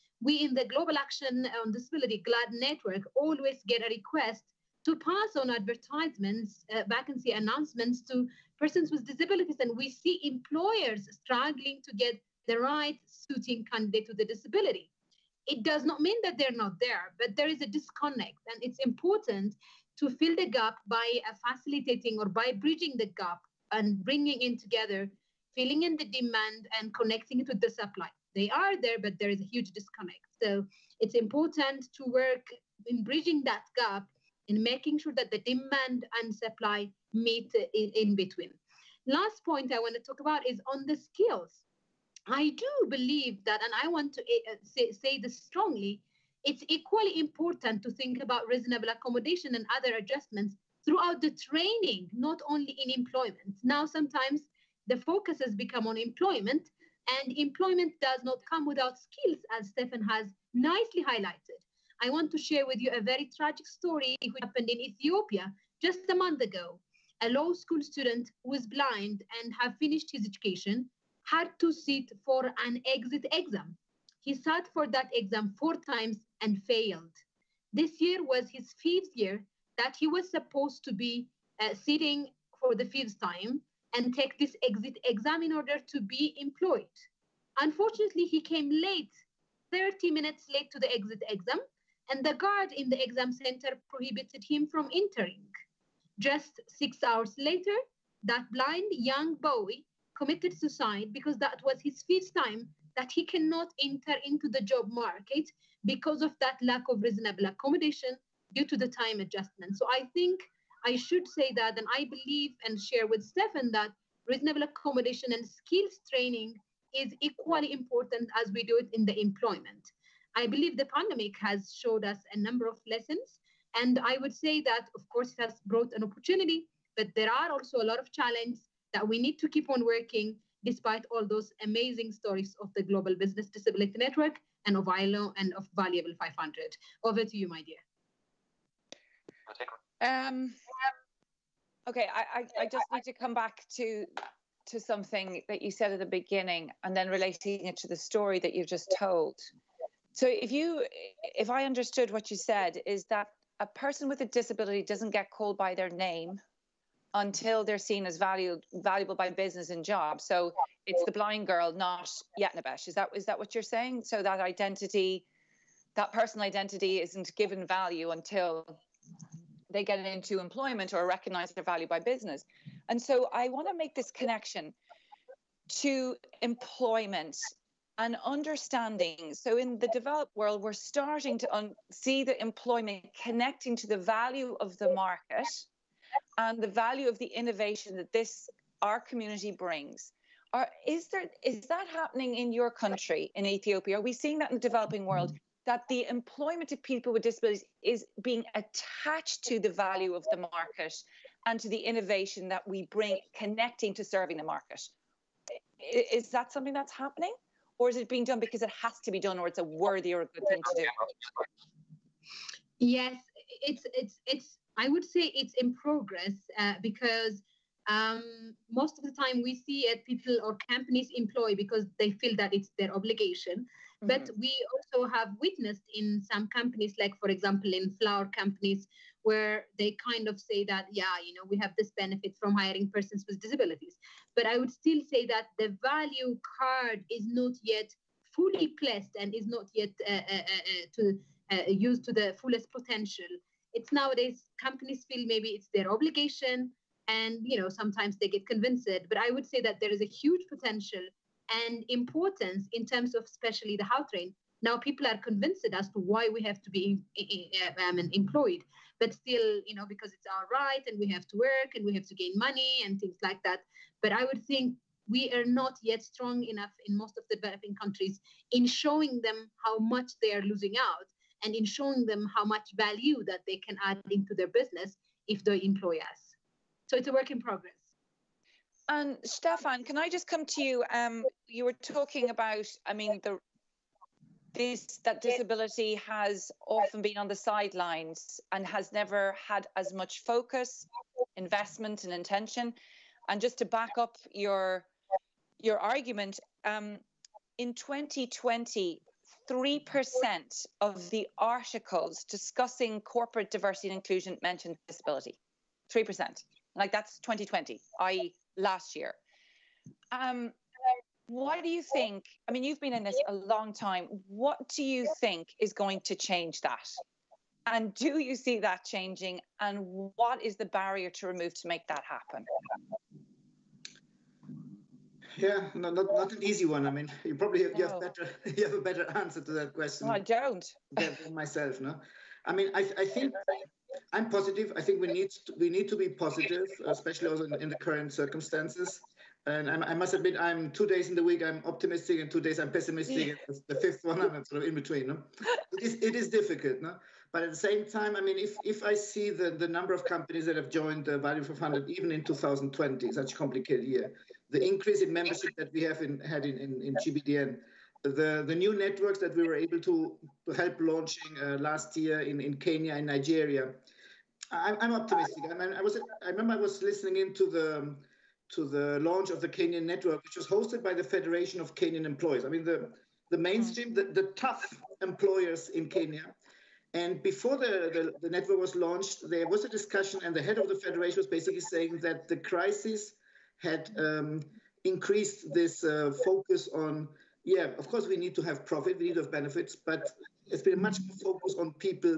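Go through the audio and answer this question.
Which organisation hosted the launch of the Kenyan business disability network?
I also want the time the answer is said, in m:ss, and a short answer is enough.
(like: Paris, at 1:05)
Federation of Kenyan Employees, at 6:11.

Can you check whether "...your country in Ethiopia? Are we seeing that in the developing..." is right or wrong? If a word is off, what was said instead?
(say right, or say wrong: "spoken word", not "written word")
right.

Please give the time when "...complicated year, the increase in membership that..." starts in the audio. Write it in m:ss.
5:53.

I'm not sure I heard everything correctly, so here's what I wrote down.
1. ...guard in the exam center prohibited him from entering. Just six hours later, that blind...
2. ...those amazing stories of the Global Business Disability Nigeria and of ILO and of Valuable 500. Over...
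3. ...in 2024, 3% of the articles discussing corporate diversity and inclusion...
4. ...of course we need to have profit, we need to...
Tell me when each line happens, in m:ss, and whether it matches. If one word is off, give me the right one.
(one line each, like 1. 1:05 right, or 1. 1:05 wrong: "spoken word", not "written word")
1. 1:32 right
2. 2:11 wrong: "Network", not "Nigeria"
3. 4:57 wrong: "2020", not "2024"
4. 6:27 right.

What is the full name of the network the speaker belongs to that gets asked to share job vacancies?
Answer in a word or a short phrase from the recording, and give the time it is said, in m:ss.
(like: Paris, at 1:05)
Global Action on Disability, at 0:00.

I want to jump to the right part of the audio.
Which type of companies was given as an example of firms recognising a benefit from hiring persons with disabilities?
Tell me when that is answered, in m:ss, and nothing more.
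3:48.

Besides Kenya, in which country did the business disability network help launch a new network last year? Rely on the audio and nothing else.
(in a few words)
Nigeria.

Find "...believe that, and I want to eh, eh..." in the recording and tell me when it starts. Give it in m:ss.
0:42.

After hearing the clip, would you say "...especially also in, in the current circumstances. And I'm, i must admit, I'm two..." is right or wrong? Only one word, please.
right.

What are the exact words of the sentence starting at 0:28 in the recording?
They are there, but there is a huge disconnect.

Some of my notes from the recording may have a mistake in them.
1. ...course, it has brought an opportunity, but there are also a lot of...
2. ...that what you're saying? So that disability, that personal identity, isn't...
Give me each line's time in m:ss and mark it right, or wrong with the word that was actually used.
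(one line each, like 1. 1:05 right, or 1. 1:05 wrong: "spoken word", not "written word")
1. 2:05 right
2. 2:43 wrong: "identity", not "disability".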